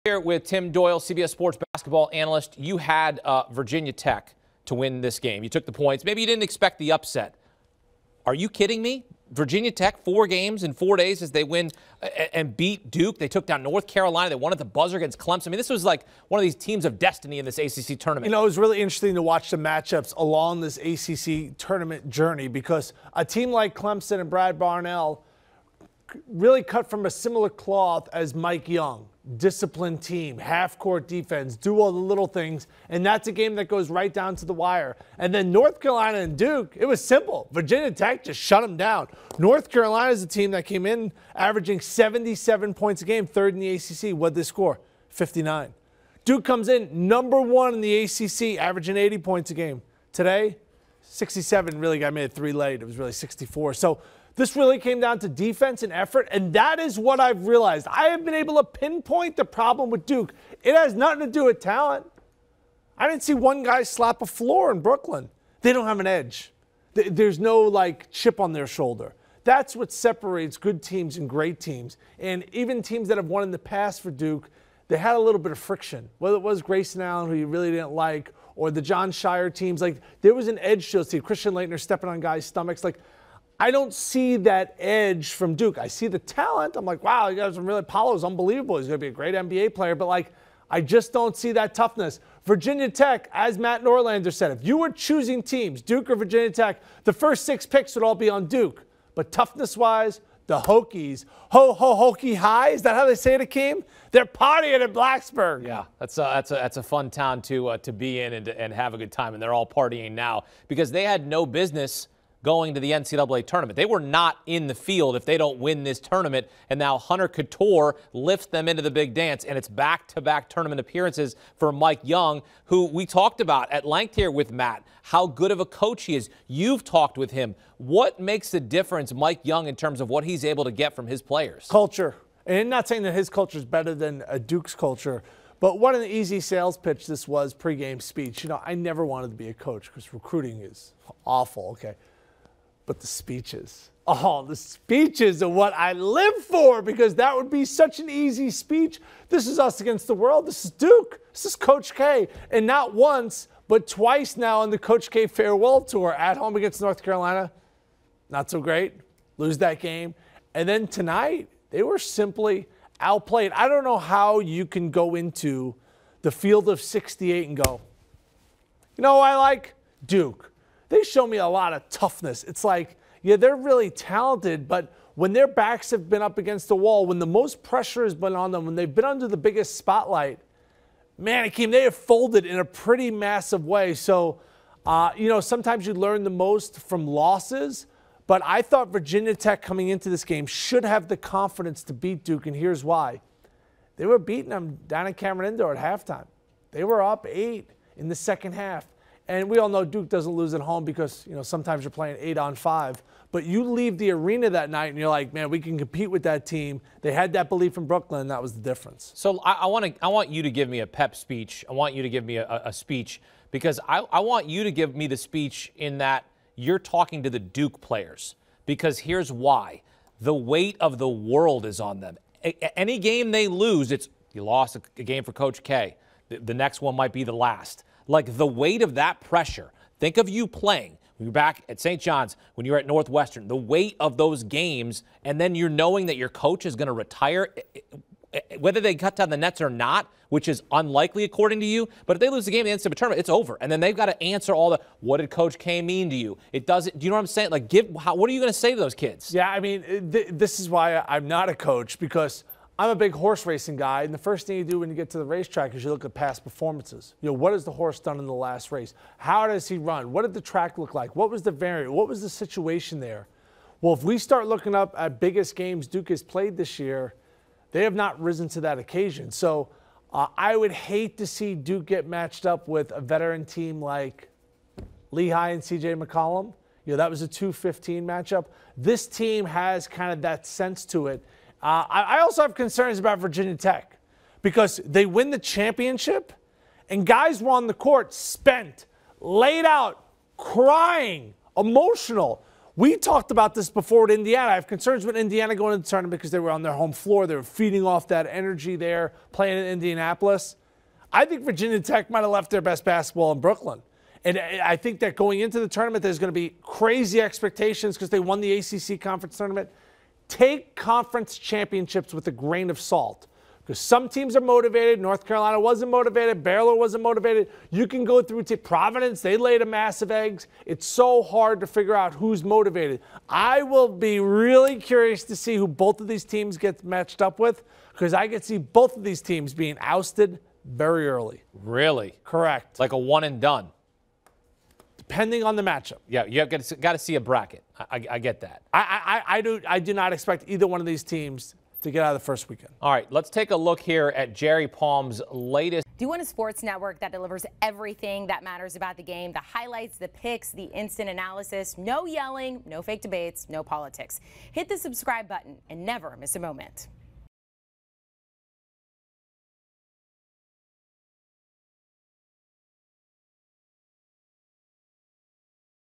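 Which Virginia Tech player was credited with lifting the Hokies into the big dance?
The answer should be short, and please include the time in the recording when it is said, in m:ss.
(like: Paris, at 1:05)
Hunter Cattoor, at 1:56.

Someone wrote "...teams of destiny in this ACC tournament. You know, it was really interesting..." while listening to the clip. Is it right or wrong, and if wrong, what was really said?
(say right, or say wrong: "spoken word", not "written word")
right.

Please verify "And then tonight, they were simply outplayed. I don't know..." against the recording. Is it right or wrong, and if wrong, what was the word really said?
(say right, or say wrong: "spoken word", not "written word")
right.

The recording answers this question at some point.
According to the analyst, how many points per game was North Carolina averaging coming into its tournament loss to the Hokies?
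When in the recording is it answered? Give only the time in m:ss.
0:41.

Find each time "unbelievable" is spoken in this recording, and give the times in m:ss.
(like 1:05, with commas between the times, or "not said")
1:28.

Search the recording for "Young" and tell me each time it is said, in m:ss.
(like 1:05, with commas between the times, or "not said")
0:28, 2:02, 2:09.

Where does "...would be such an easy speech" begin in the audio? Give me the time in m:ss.
2:27.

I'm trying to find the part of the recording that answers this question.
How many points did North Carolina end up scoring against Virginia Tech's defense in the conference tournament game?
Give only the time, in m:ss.
0:45.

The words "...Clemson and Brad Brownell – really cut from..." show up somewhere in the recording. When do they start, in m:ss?
0:23.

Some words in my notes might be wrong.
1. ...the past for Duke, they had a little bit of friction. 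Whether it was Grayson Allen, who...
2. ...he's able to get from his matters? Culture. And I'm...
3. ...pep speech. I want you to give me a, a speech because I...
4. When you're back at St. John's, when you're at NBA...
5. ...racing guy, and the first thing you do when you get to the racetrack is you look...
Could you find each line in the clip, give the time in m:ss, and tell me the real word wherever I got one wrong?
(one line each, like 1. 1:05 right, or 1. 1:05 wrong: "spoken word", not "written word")
1. 1:13 right
2. 2:10 wrong: "players", not "matters"
3. 3:30 right
4. 3:51 wrong: "Northwestern", not "NBA"
5. 4:13 right.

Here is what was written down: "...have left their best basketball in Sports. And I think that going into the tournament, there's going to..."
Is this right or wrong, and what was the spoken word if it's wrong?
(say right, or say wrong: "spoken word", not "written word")
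wrong: "Brooklyn", not "Sports".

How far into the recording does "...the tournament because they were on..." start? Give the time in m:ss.
4:55.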